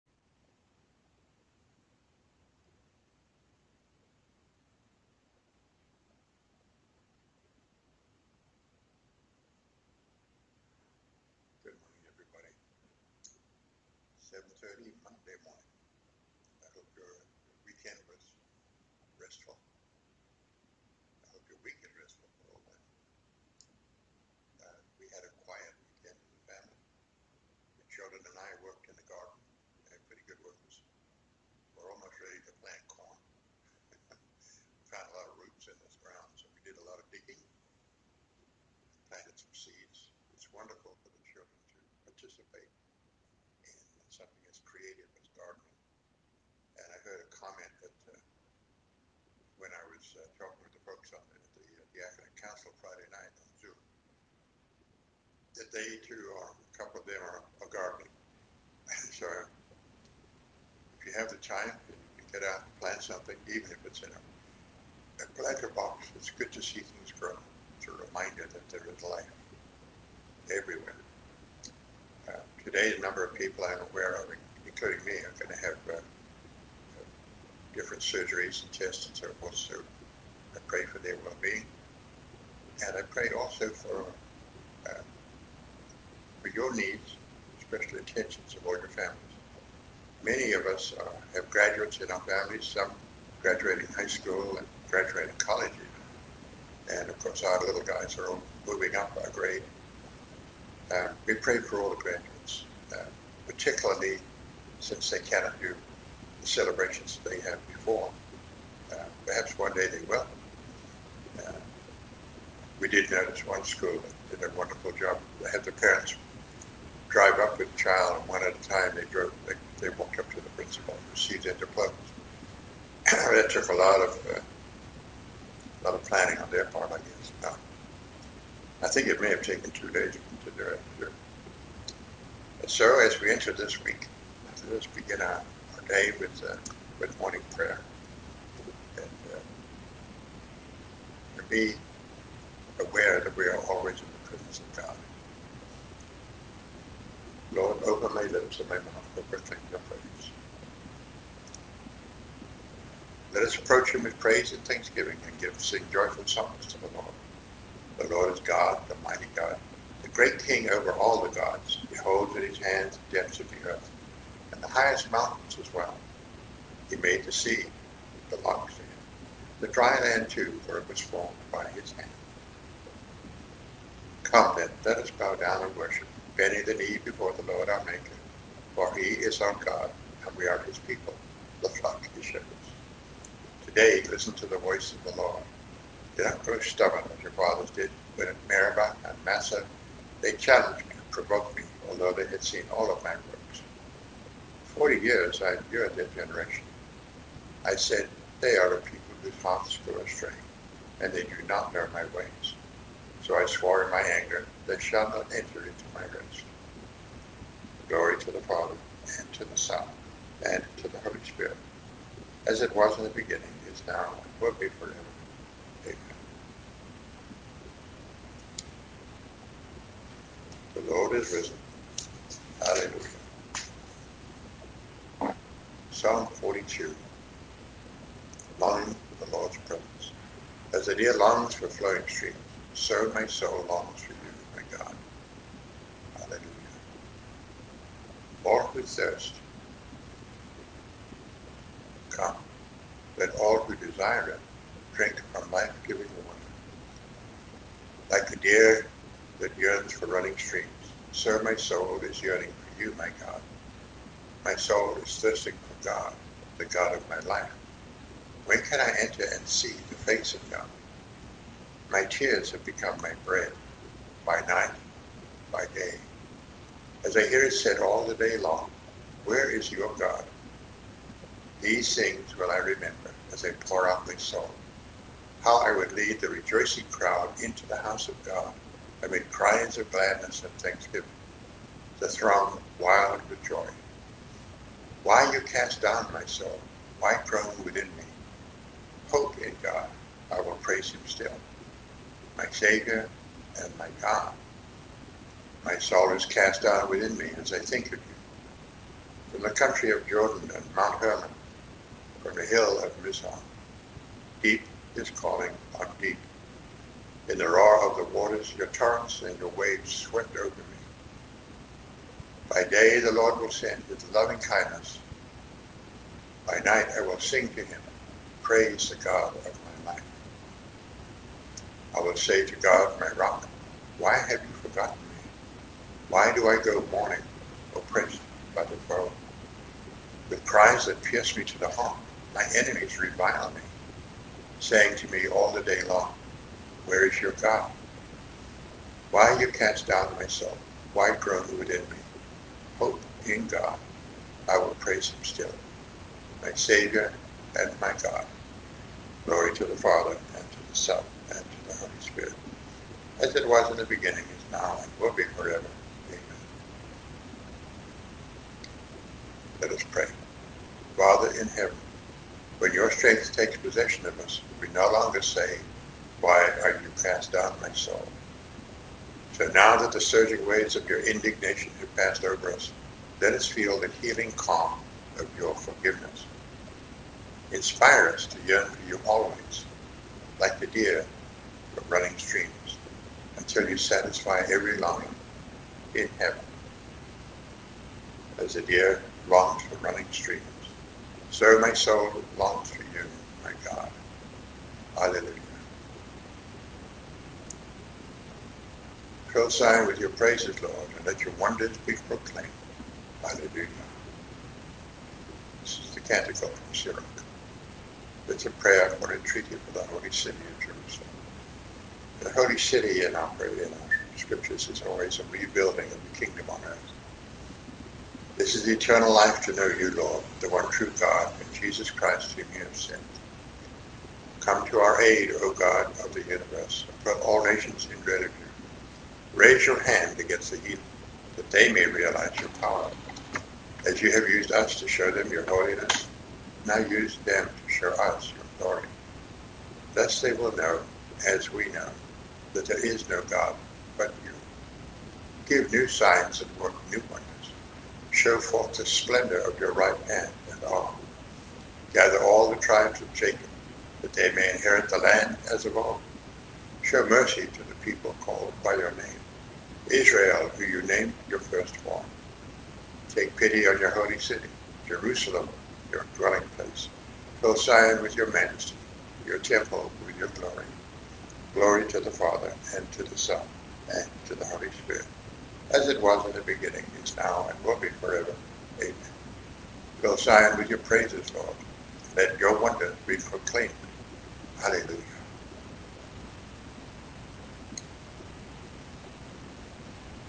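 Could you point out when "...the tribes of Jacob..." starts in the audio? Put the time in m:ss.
7:32.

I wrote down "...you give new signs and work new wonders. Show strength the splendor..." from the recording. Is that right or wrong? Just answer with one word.
wrong.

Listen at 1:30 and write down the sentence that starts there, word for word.
Many of us uh, have graduates in our families, some graduating high school and graduating college even.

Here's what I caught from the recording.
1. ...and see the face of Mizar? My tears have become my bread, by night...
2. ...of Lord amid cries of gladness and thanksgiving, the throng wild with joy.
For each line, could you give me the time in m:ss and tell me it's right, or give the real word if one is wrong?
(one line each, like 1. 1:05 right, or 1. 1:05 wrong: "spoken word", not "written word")
1. 4:19 wrong: "God", not "Mizar"
2. 4:38 wrong: "God", not "Lord".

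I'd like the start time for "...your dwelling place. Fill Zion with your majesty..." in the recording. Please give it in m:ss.
7:45.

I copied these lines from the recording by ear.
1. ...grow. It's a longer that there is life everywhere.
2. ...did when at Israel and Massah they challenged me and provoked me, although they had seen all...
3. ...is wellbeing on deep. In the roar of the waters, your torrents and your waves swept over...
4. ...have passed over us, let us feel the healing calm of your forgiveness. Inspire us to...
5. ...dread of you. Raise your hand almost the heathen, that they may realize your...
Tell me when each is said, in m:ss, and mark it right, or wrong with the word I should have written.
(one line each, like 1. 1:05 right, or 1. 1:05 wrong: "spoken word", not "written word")
1. 1:07 wrong: "reminder", not "longer"
2. 3:07 wrong: "Meribah", not "Israel"
3. 5:04 wrong: "calling", not "wellbeing"
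4. 6:11 right
5. 7:08 wrong: "against", not "almost".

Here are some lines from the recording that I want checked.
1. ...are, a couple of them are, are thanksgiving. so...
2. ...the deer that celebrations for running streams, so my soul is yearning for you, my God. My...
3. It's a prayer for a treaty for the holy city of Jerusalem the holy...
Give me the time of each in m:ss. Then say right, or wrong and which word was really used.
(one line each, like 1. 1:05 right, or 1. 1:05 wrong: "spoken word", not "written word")
1. 0:56 wrong: "gardening", not "thanksgiving"
2. 4:08 wrong: "yearns", not "celebrations"
3. 6:48 right.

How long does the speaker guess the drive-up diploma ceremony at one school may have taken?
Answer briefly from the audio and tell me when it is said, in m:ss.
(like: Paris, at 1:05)
Two days, at 2:09.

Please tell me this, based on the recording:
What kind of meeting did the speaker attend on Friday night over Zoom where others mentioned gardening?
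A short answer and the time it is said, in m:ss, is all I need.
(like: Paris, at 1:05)
Academic council, at 0:52.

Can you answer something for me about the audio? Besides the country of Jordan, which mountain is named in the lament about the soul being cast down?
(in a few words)
Mount Hermon.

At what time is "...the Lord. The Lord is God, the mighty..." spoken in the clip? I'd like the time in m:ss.
2:36.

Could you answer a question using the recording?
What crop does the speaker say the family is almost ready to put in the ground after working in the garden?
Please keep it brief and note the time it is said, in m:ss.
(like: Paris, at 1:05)
Corn, at 0:32.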